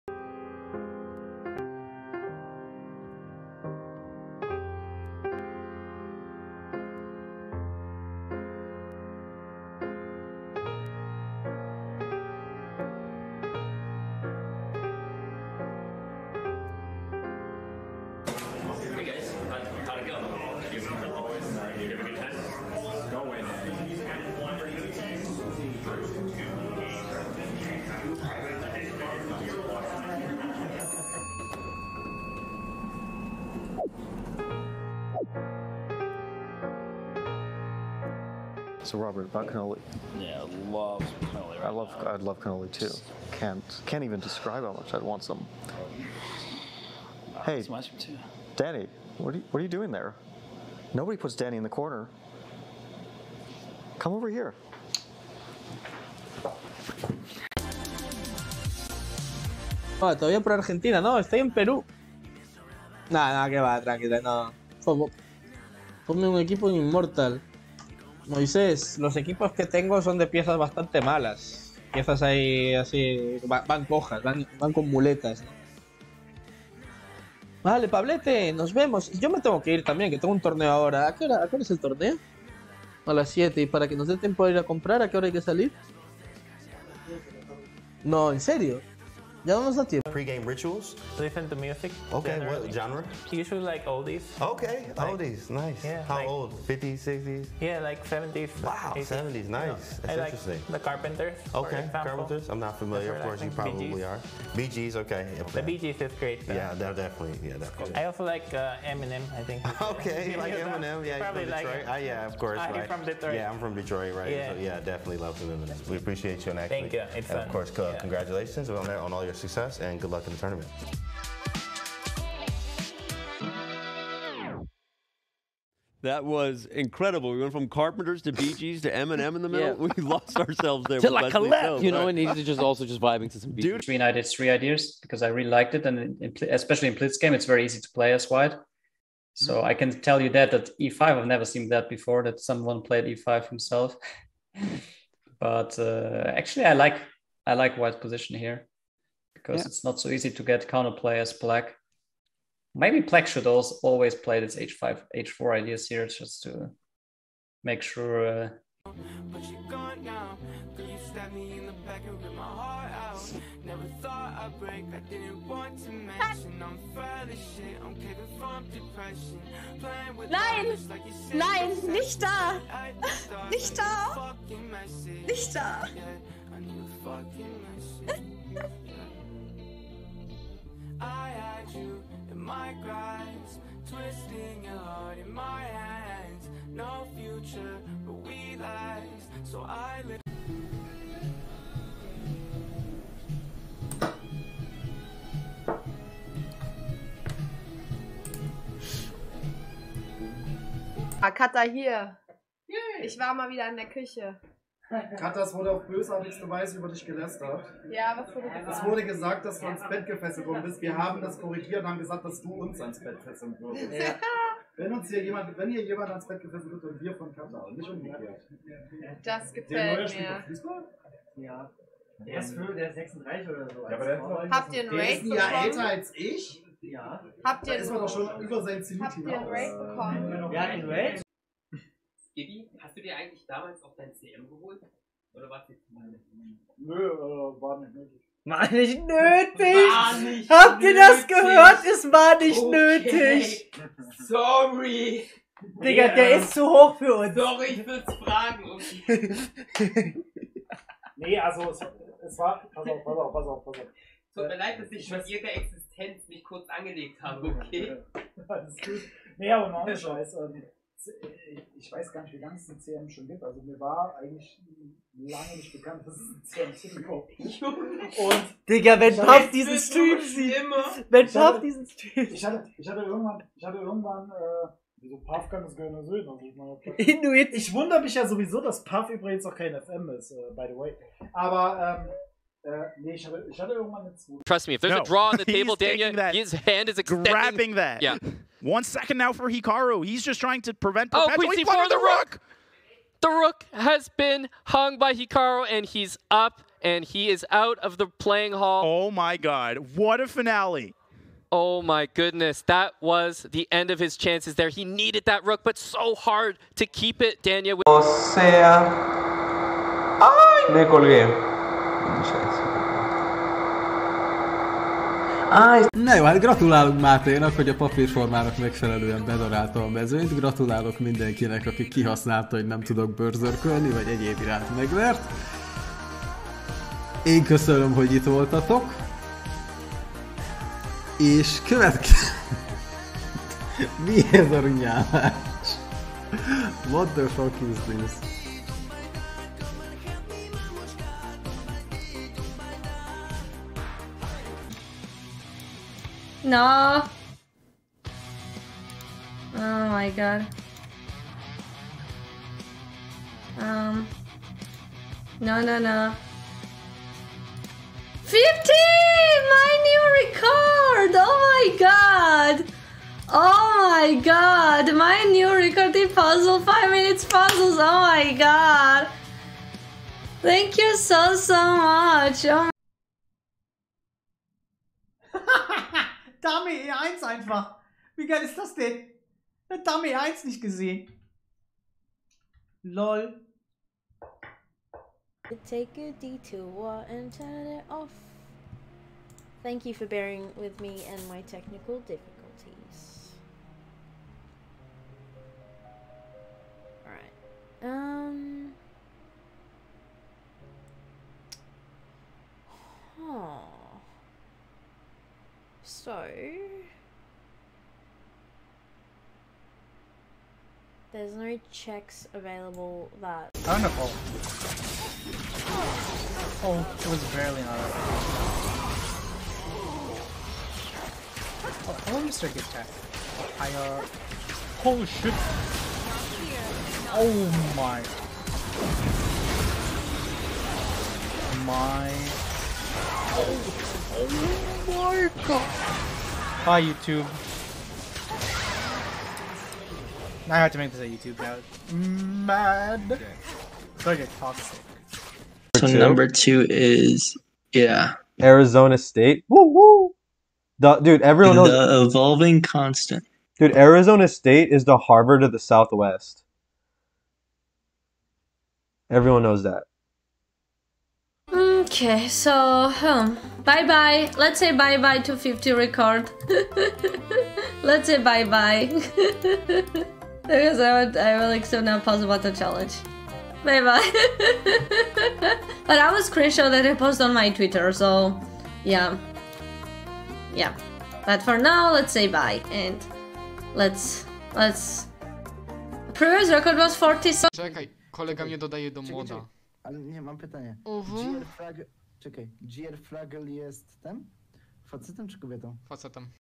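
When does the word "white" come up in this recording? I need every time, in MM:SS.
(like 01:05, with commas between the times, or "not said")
02:18, 02:27.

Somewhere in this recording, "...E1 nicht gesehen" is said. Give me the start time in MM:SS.
06:20.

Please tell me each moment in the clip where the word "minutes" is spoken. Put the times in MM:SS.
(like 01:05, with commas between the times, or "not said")
06:06.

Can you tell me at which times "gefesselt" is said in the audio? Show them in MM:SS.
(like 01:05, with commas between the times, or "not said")
03:30, 03:36.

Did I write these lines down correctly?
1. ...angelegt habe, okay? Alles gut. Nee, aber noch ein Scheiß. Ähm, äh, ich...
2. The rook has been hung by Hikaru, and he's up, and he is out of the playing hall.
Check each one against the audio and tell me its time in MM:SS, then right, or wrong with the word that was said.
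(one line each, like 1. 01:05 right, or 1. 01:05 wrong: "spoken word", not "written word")
1. 04:16 right
2. 04:53 right.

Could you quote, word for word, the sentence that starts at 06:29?
Thank you for bearing with me and my technical difficulties.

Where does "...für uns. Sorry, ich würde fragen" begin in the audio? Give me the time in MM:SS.
04:06.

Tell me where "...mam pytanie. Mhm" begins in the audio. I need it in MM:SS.
08:10.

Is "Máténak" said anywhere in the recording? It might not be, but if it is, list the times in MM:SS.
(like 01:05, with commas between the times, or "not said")
05:17.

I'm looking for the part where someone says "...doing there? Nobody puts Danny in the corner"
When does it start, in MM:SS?
00:49.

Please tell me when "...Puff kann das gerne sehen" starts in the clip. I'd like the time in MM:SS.
04:35.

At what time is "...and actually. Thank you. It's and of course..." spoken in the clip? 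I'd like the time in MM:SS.
01:56.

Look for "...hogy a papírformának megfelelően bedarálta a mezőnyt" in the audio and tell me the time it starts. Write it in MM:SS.
05:17.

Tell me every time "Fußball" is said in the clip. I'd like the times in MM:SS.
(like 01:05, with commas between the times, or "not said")
03:40.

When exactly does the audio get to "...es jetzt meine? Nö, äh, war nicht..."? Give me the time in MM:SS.
03:55.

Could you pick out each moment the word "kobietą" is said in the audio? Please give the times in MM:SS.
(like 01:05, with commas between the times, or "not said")
08:15.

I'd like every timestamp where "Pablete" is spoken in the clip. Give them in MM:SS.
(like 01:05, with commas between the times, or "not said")
01:17.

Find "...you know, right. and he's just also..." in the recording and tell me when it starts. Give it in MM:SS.
02:11.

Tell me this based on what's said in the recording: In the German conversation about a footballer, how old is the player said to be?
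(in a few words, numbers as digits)
36.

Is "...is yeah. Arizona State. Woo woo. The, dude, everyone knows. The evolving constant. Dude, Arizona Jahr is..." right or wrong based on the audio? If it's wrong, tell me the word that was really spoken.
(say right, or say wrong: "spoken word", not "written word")
wrong: "State", not "Jahr".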